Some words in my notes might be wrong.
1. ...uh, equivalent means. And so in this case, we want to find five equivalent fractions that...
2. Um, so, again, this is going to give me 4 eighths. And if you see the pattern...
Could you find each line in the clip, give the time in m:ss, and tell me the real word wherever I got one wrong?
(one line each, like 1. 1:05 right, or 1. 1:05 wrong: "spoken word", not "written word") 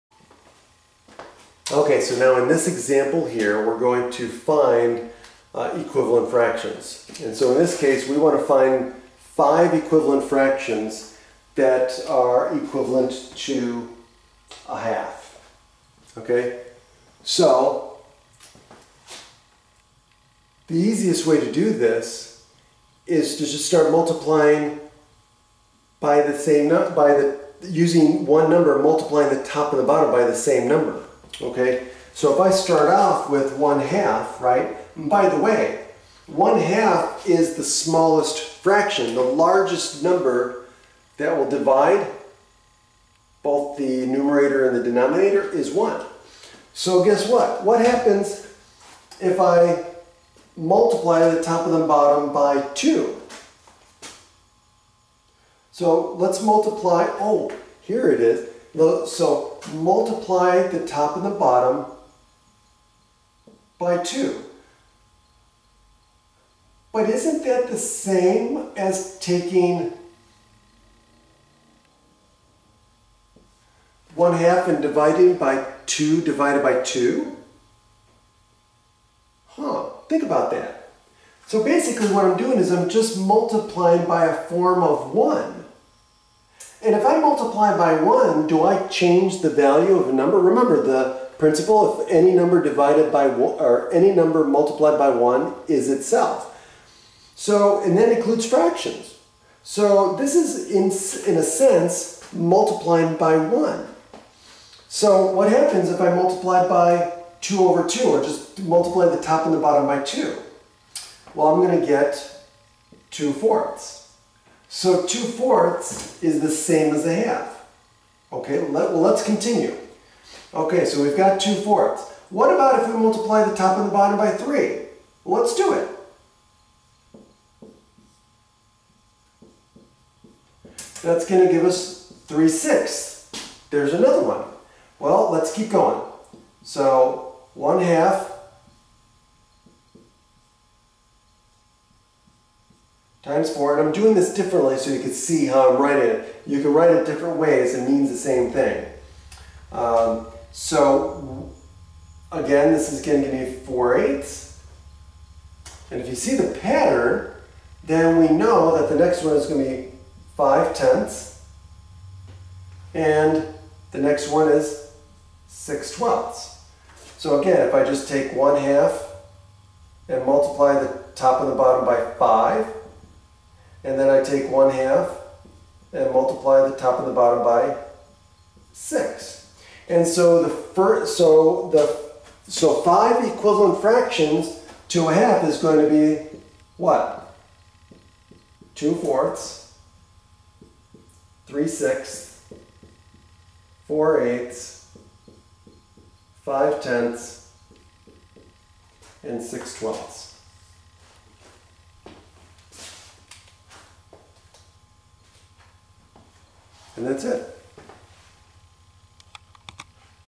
1. 0:05 wrong: "fractions", not "means"
2. 2:29 right.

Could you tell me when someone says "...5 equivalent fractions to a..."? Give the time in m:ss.
3:02.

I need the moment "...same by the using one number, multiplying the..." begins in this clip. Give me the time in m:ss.
0:26.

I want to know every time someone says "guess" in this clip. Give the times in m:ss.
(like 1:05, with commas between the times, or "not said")
0:47.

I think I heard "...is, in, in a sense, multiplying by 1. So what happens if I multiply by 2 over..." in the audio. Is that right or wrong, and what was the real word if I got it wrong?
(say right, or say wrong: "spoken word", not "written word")
right.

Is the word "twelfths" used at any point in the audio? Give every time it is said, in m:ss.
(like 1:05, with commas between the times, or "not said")
2:45, 3:19.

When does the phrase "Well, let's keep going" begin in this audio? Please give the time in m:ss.
2:14.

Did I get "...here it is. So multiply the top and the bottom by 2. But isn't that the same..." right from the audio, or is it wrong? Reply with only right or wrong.
right.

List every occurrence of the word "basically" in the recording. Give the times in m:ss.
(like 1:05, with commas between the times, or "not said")
1:21.